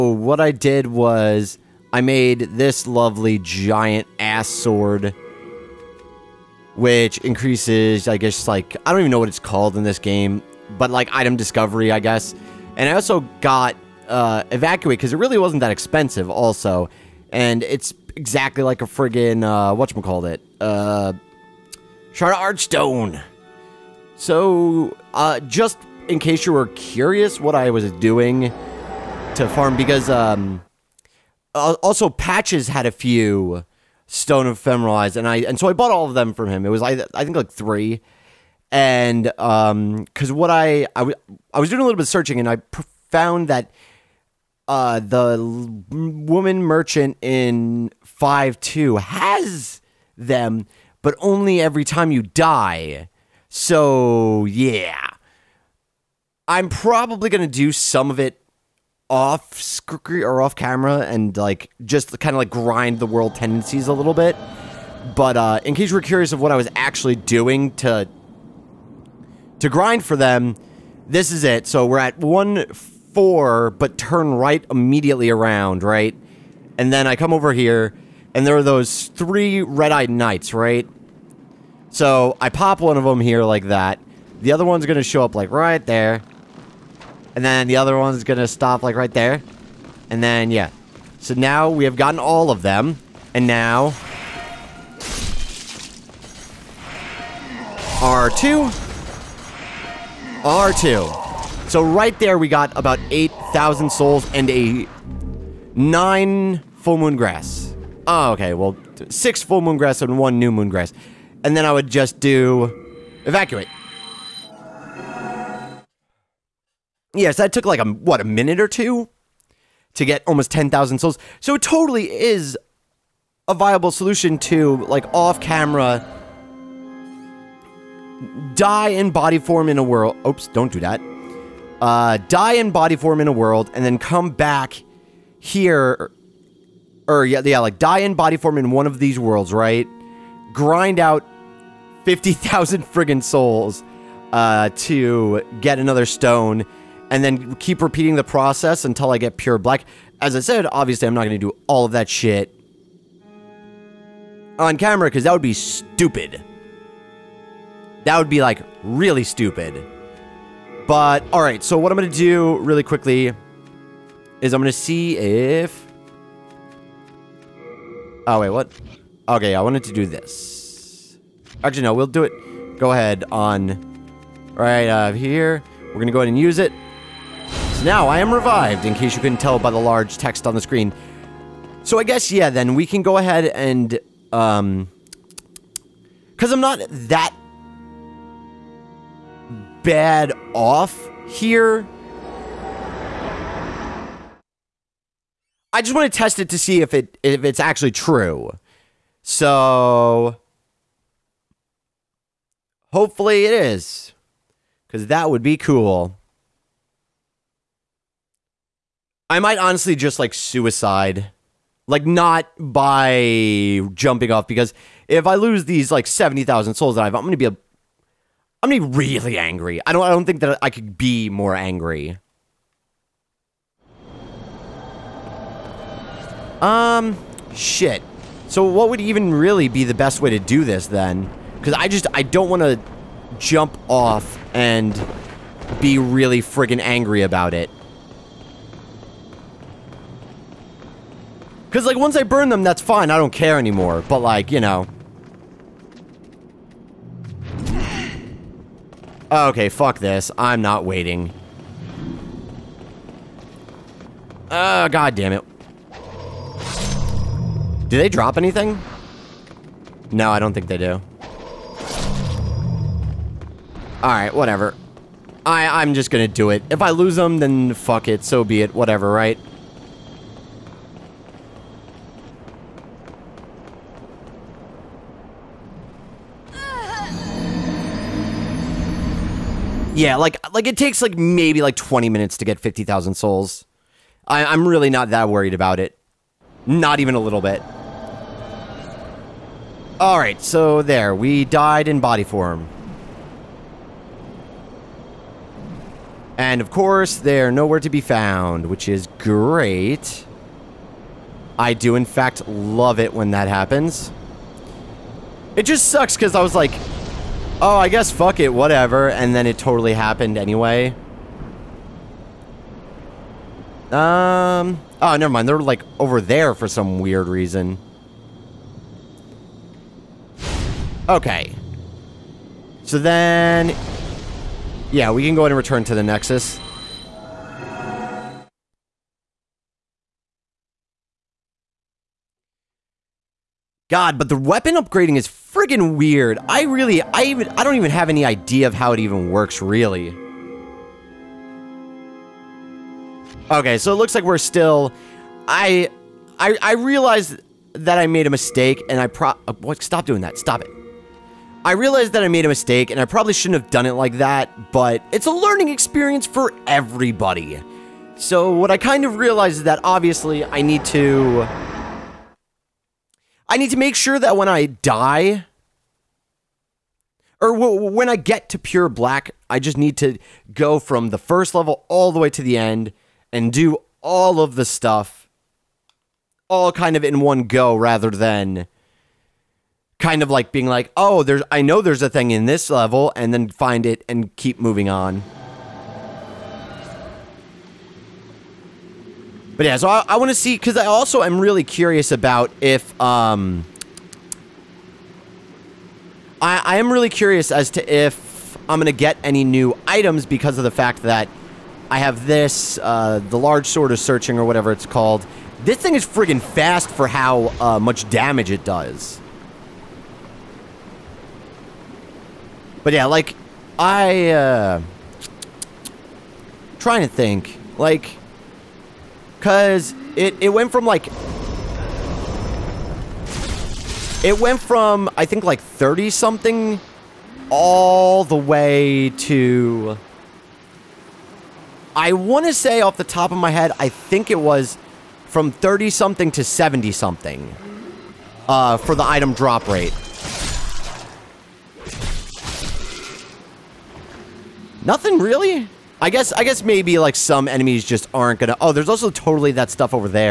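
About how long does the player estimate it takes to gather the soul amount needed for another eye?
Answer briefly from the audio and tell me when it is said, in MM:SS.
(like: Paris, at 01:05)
20 minutes, at 04:41.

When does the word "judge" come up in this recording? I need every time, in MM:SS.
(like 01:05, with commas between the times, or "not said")
not said.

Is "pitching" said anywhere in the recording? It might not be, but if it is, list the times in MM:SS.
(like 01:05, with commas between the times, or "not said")
not said.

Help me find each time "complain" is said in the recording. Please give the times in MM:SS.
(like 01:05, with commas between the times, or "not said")
not said.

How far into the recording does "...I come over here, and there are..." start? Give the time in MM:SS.
01:17.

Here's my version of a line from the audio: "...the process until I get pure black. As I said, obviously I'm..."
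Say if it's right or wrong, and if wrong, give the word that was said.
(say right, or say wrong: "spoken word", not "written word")
right.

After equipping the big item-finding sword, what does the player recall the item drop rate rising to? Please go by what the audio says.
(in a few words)
70-something.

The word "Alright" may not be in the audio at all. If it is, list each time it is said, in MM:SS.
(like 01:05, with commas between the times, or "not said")
04:24, 04:49.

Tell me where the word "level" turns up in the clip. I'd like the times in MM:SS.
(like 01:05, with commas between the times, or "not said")
06:11, 06:22.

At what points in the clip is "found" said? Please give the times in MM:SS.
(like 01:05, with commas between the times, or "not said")
00:43, 04:58.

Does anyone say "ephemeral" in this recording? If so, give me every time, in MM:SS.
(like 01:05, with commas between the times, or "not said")
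00:34.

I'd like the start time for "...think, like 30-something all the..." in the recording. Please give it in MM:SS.
07:05.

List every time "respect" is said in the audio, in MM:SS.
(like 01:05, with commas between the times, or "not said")
not said.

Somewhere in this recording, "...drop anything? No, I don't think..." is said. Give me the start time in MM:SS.
04:18.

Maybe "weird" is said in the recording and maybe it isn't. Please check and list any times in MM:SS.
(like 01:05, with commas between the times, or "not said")
05:16, 05:35.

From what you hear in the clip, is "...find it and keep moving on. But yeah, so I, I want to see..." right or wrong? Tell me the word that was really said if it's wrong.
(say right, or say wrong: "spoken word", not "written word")
right.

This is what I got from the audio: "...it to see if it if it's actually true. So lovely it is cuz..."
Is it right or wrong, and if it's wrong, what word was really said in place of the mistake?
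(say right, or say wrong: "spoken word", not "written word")
wrong: "hopefully", not "lovely".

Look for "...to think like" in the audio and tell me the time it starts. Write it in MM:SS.
06:57.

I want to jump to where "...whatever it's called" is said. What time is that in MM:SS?
06:44.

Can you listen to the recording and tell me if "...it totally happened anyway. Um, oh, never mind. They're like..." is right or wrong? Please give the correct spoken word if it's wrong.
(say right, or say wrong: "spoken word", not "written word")
right.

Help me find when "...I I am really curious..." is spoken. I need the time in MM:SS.
06:36.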